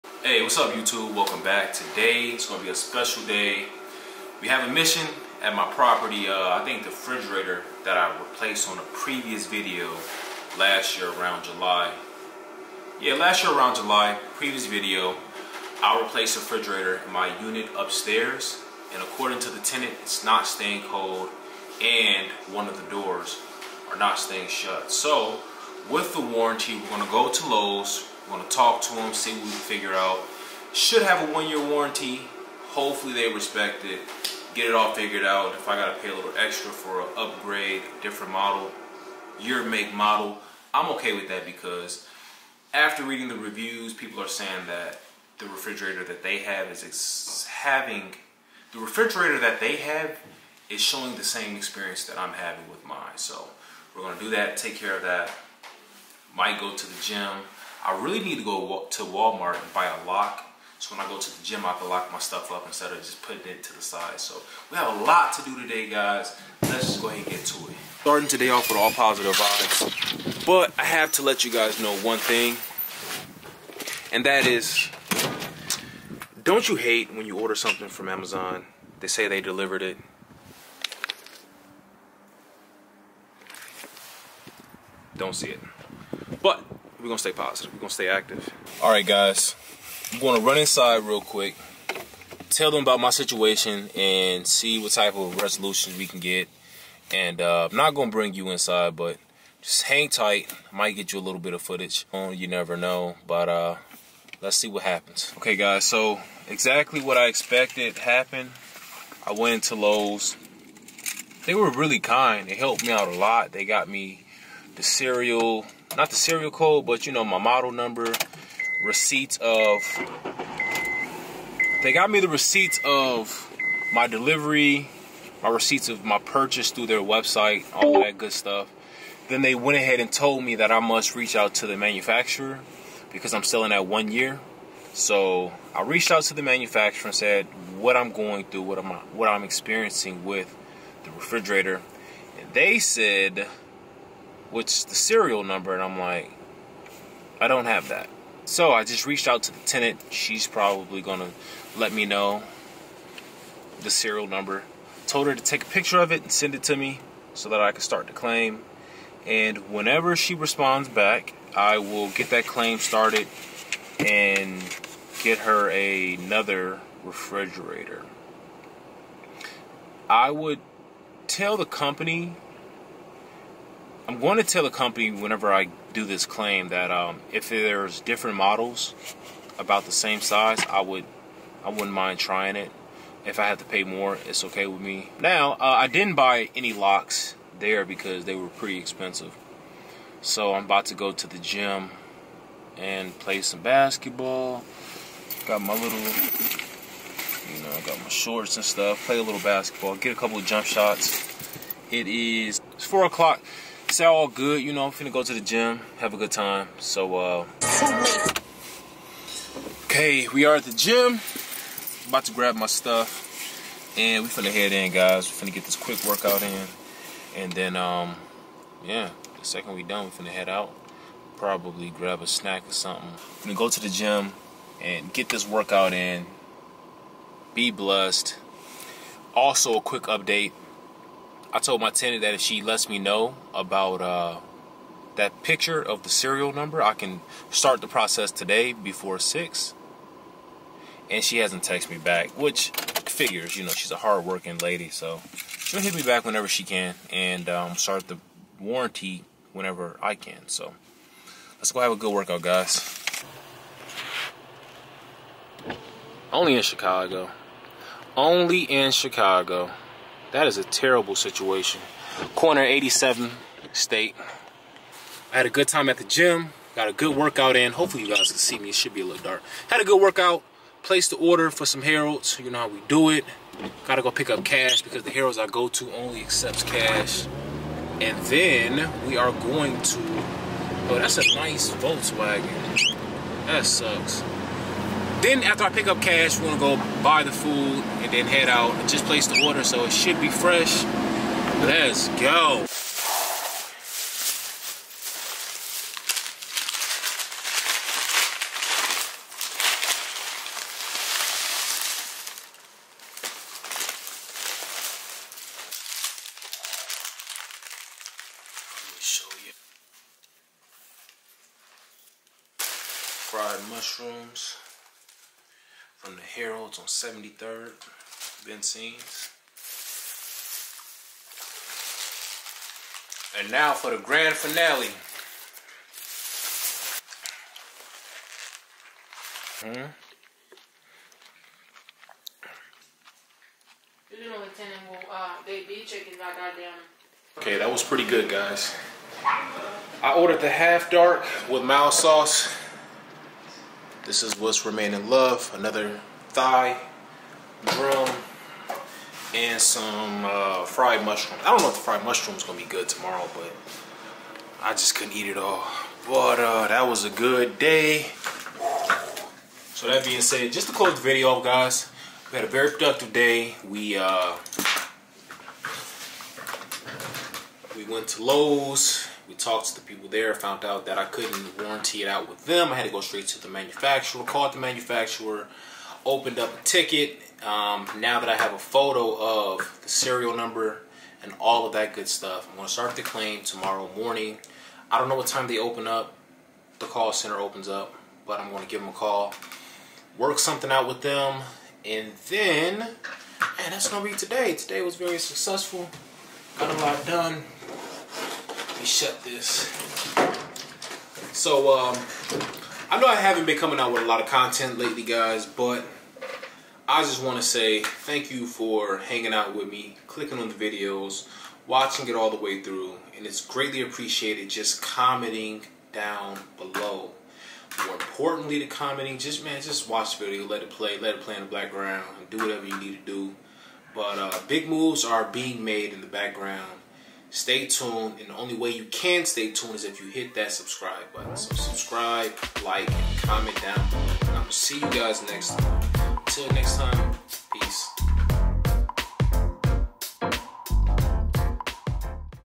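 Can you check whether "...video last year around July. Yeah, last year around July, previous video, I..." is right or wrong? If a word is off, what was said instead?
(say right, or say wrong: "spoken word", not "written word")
right.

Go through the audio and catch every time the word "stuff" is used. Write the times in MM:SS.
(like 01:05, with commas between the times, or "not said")
01:02, 02:08, 03:18, 03:32, 06:22.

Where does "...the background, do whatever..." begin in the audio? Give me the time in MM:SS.
07:01.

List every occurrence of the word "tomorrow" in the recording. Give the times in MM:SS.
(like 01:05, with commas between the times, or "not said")
05:52, 06:23.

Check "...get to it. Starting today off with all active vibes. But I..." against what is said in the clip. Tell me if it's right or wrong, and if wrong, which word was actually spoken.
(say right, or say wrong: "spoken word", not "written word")
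wrong: "positive", not "active".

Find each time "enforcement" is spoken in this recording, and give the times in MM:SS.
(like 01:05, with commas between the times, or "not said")
not said.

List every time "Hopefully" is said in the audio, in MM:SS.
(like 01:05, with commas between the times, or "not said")
00:32, 04:27.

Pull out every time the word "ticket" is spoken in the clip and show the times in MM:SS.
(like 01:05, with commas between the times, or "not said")
06:16.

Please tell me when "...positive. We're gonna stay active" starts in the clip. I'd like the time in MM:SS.
01:27.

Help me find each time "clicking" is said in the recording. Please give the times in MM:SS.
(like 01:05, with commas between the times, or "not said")
06:50.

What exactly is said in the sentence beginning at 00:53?
So we're going to do that, take care of that.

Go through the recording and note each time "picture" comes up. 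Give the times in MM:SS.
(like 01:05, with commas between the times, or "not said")
02:35, 03:55.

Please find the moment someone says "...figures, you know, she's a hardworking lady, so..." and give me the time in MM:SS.
04:03.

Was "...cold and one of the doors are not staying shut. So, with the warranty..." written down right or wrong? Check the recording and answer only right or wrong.
right.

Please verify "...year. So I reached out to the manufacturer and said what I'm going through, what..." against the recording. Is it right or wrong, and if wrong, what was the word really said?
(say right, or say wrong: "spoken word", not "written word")
right.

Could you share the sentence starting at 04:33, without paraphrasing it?
Gotta go pick up cash because the Harold's I go to only accepts cash.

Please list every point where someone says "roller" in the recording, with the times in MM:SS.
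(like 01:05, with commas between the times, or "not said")
not said.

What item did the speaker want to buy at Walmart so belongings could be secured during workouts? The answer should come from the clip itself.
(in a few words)
A lock.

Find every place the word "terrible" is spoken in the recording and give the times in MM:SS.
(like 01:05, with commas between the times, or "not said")
04:20.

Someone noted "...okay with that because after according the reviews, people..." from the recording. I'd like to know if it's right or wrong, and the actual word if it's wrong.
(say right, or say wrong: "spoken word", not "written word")
wrong: "reading", not "according".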